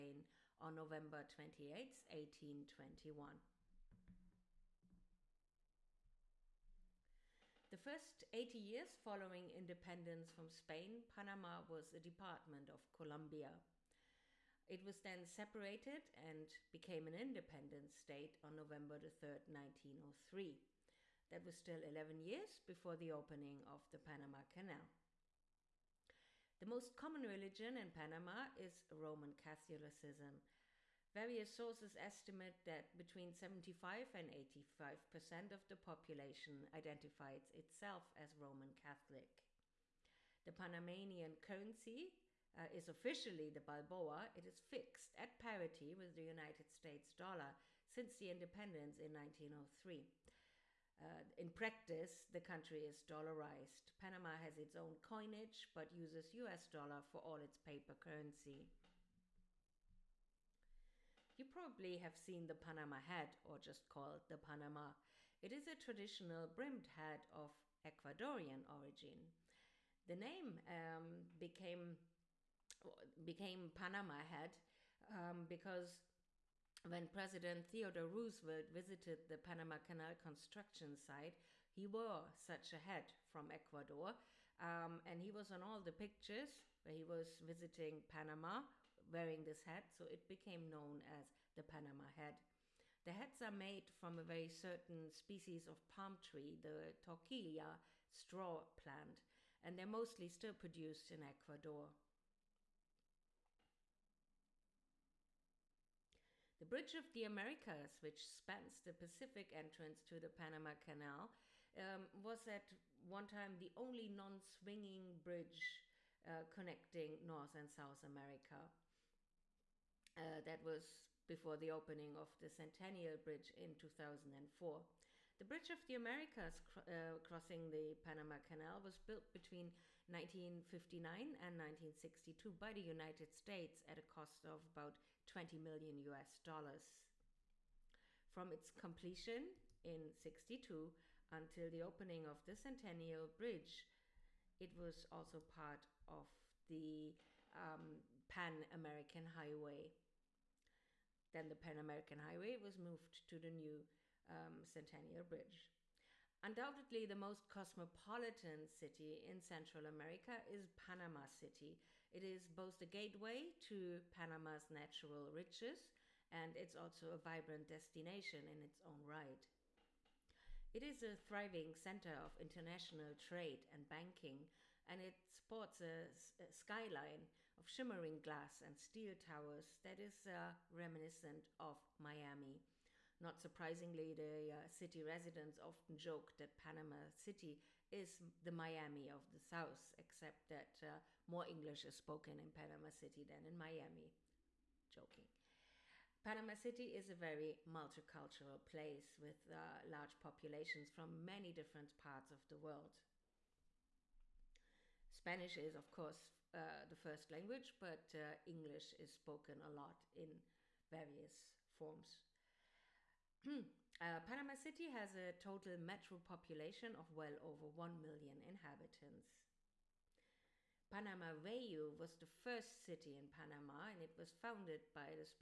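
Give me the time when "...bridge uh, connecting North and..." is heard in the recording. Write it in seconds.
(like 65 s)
115 s.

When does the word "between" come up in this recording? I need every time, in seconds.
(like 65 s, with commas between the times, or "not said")
32 s, 129 s.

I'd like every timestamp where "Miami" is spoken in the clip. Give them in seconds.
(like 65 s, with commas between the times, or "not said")
181 s, 188 s, 193 s.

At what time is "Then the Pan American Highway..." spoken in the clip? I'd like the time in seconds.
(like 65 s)
151 s.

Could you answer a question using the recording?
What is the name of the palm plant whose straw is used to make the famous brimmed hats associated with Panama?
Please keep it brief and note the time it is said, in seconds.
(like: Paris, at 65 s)
Toquilla straw plant, at 97 s.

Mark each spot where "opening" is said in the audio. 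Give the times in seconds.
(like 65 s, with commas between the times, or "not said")
23 s, 121 s, 141 s.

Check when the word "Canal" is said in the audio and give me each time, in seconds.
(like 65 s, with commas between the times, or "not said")
24 s, 79 s, 110 s, 128 s.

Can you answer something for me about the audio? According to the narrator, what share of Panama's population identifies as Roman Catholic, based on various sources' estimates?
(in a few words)
75 to 85 percent.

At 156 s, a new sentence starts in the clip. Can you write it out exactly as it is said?
Undoubtedly, the most cosmopolitan city in Central America is Panama City.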